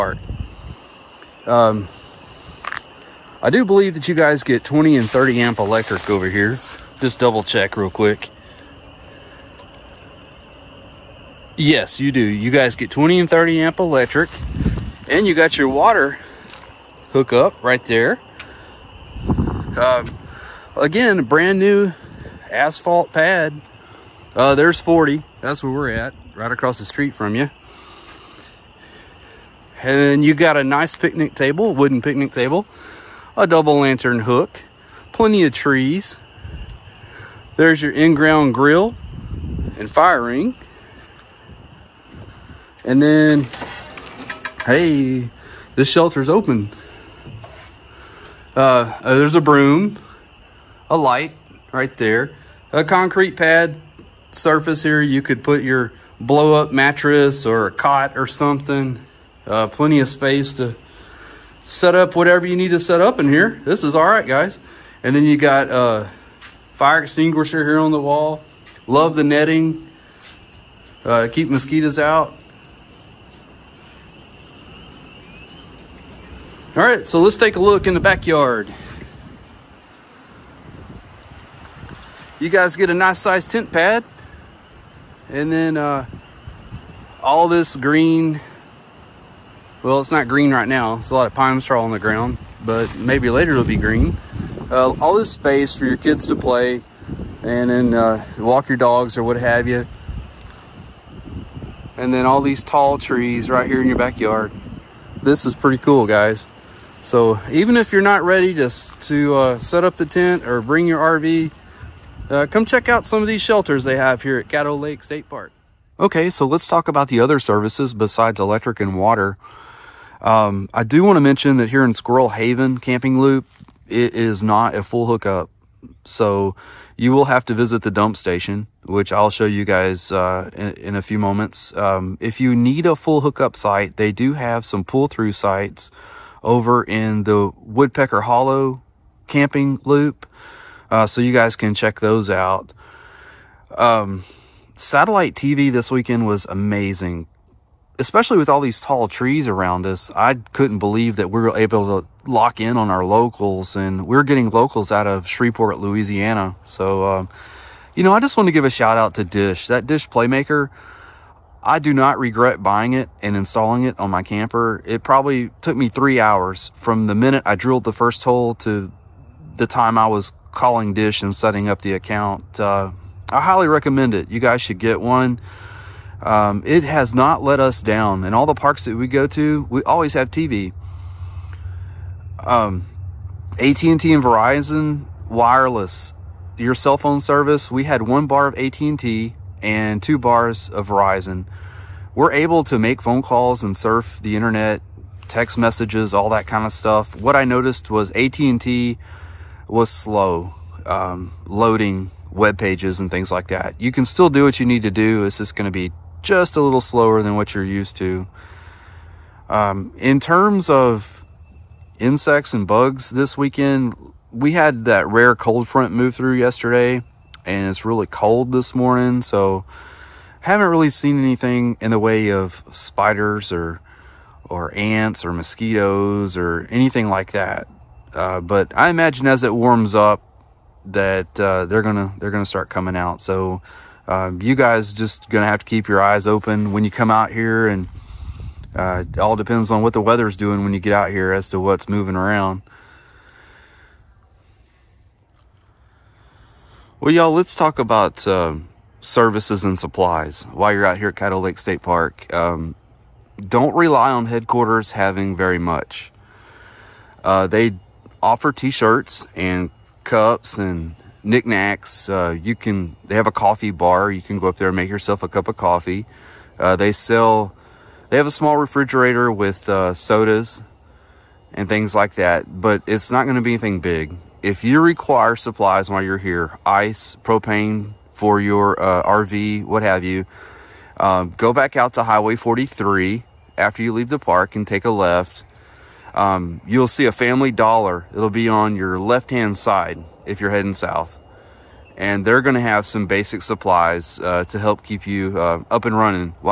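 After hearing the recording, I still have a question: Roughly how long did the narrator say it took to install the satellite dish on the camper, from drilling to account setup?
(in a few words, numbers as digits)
3 hours.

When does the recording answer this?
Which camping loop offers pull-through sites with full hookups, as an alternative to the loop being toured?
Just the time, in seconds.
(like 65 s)
137 s.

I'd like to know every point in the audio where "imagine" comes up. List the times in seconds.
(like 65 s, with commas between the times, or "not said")
228 s.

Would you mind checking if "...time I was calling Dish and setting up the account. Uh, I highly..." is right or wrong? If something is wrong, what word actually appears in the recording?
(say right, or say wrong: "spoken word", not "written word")
right.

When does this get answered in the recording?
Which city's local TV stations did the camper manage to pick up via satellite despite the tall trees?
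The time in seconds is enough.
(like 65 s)
155 s.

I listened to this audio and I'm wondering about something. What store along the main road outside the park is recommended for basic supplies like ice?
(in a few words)
Family Dollar.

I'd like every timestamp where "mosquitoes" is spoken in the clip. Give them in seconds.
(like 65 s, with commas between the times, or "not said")
71 s, 225 s.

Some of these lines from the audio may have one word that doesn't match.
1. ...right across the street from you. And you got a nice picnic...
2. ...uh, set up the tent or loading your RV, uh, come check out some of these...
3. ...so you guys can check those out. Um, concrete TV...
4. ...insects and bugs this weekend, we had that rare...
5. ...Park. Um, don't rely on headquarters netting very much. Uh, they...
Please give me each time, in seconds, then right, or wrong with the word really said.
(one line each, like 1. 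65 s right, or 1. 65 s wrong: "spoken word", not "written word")
1. 26 s right
2. 109 s wrong: "bring", not "loading"
3. 141 s wrong: "satellite", not "concrete"
4. 211 s right
5. 251 s wrong: "having", not "netting".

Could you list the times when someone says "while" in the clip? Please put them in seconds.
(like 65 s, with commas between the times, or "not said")
250 s, 275 s.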